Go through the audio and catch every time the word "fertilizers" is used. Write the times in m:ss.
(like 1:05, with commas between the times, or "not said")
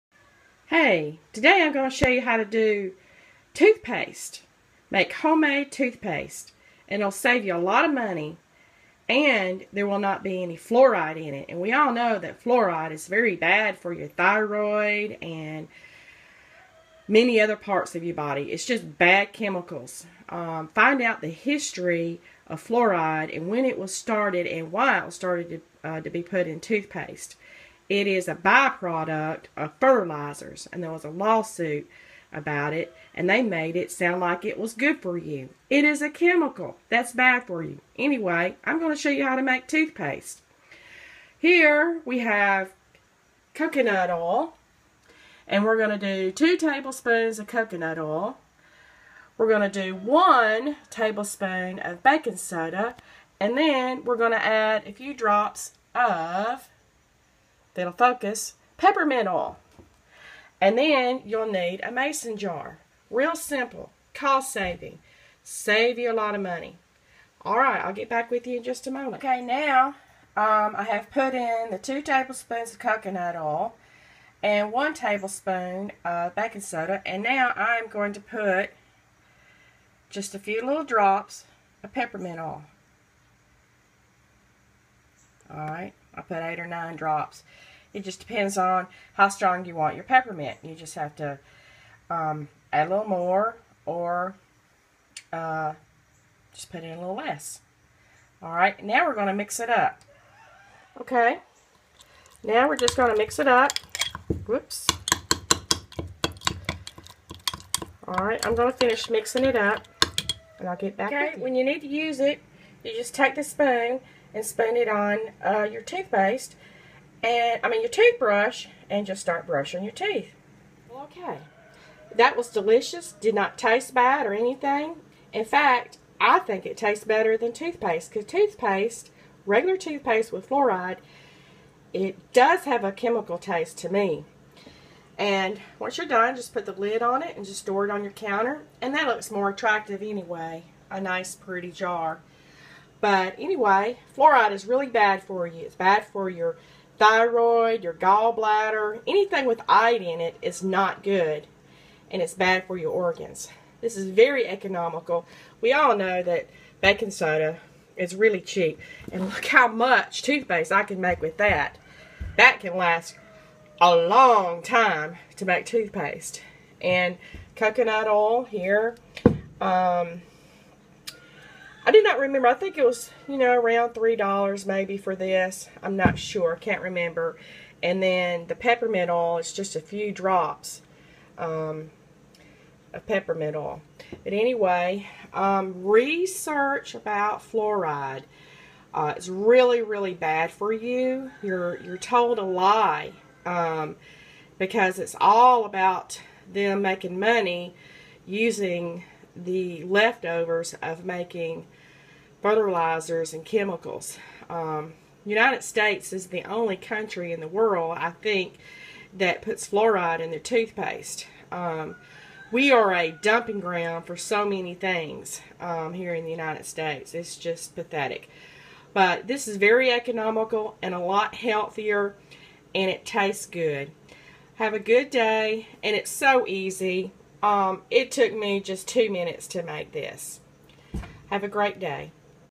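0:29, 3:22.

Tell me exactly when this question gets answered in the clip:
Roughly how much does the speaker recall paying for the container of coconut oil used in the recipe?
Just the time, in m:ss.
2:53.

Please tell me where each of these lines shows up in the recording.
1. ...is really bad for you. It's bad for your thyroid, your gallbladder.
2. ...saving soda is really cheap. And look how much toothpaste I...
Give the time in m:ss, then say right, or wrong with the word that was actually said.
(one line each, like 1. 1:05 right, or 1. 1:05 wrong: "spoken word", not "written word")
1. 2:24 right
2. 2:36 wrong: "baking", not "saving".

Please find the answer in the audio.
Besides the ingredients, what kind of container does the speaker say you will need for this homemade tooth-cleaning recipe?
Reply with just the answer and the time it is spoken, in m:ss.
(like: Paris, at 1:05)
Mason jar, at 1:01.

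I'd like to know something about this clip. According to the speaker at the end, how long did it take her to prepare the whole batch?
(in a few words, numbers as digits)
2 minutes.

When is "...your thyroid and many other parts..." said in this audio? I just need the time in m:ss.
0:13.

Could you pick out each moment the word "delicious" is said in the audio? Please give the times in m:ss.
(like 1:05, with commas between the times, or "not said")
2:02.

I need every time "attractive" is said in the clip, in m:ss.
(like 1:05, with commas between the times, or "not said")
2:19.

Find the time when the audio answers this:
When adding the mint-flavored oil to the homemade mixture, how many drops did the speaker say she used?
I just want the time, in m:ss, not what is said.
1:26.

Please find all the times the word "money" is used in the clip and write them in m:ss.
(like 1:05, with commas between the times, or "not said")
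0:07, 1:06, 3:17.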